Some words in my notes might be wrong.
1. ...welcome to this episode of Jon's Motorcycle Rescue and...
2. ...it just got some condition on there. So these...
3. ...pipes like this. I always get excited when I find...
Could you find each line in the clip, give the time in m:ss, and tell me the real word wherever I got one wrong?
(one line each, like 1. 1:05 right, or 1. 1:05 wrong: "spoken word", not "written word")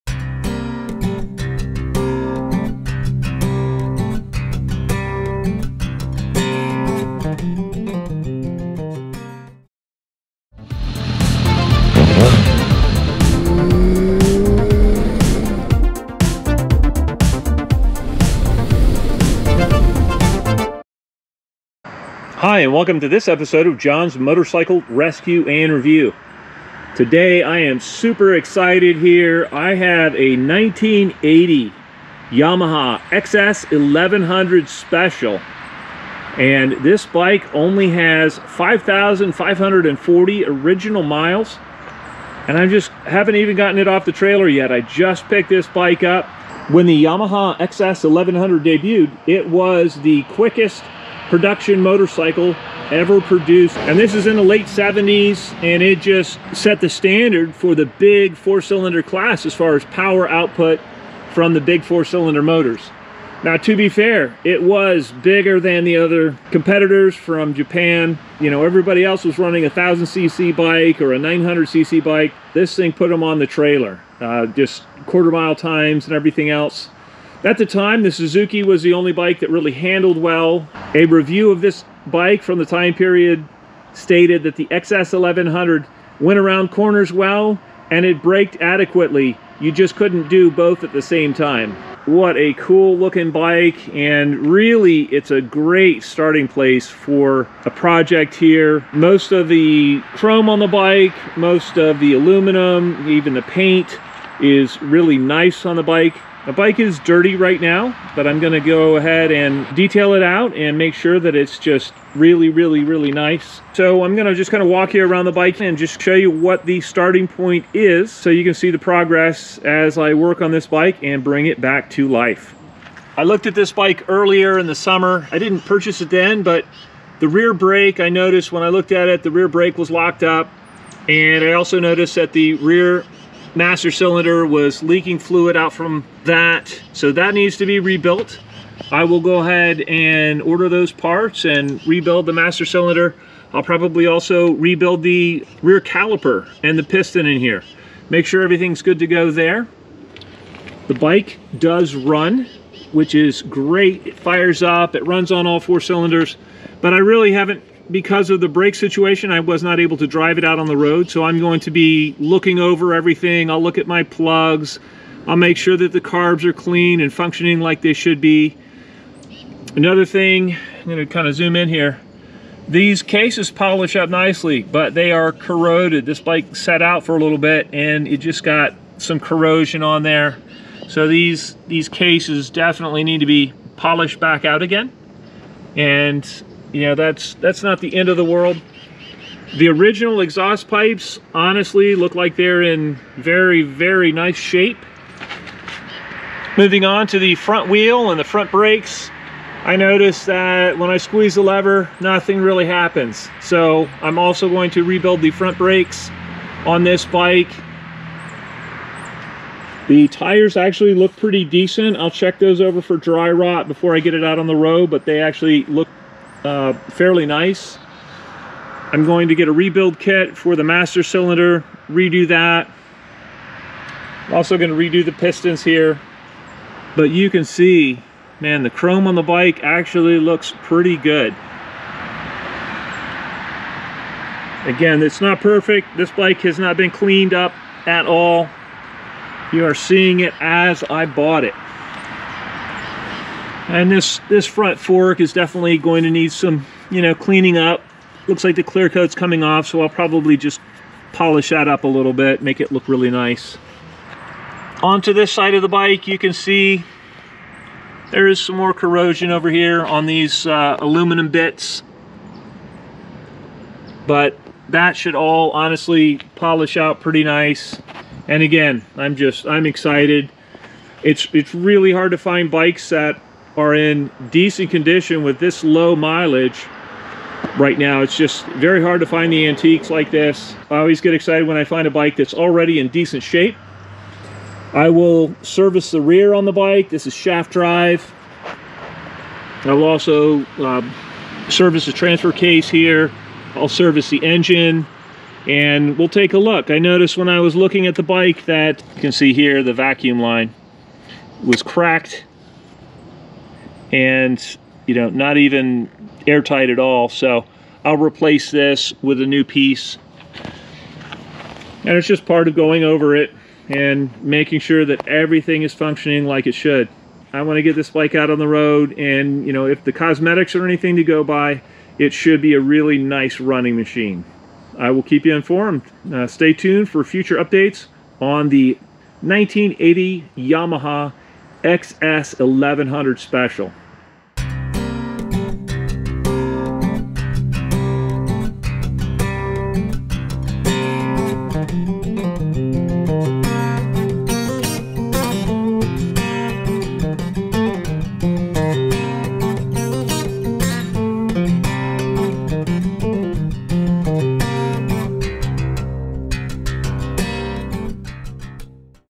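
1. 0:22 right
2. 2:58 wrong: "corrosion", not "condition"
3. 4:39 wrong: "antiques", not "pipes".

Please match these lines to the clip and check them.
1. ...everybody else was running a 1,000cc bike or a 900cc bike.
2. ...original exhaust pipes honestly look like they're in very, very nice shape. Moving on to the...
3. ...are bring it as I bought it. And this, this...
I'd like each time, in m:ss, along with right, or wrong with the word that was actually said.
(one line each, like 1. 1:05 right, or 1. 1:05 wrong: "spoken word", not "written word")
1. 1:08 right
2. 3:09 right
3. 3:59 wrong: "seeing", not "bring".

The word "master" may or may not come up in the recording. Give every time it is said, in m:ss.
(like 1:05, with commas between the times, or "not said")
2:13, 2:22, 3:40.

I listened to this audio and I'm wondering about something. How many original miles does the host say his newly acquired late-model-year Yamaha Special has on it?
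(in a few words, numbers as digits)
5,540.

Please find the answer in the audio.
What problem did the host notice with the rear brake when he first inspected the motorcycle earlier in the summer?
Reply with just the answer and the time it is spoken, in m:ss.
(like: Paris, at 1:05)
locked up, at 2:09.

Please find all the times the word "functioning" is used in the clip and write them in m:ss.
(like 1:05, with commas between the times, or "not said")
2:47, 5:15.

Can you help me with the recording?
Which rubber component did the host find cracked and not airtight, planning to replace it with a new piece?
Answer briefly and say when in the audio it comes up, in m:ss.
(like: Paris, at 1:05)
vacuum line, at 4:59.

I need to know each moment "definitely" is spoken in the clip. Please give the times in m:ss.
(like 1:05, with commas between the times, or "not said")
3:02, 4:05.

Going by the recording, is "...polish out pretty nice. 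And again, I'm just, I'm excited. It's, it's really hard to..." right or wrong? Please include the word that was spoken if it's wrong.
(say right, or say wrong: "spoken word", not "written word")
right.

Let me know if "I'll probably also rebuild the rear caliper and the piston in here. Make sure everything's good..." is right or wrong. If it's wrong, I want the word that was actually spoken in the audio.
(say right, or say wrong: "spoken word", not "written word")
right.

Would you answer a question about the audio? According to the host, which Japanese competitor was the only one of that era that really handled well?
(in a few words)
Suzuki.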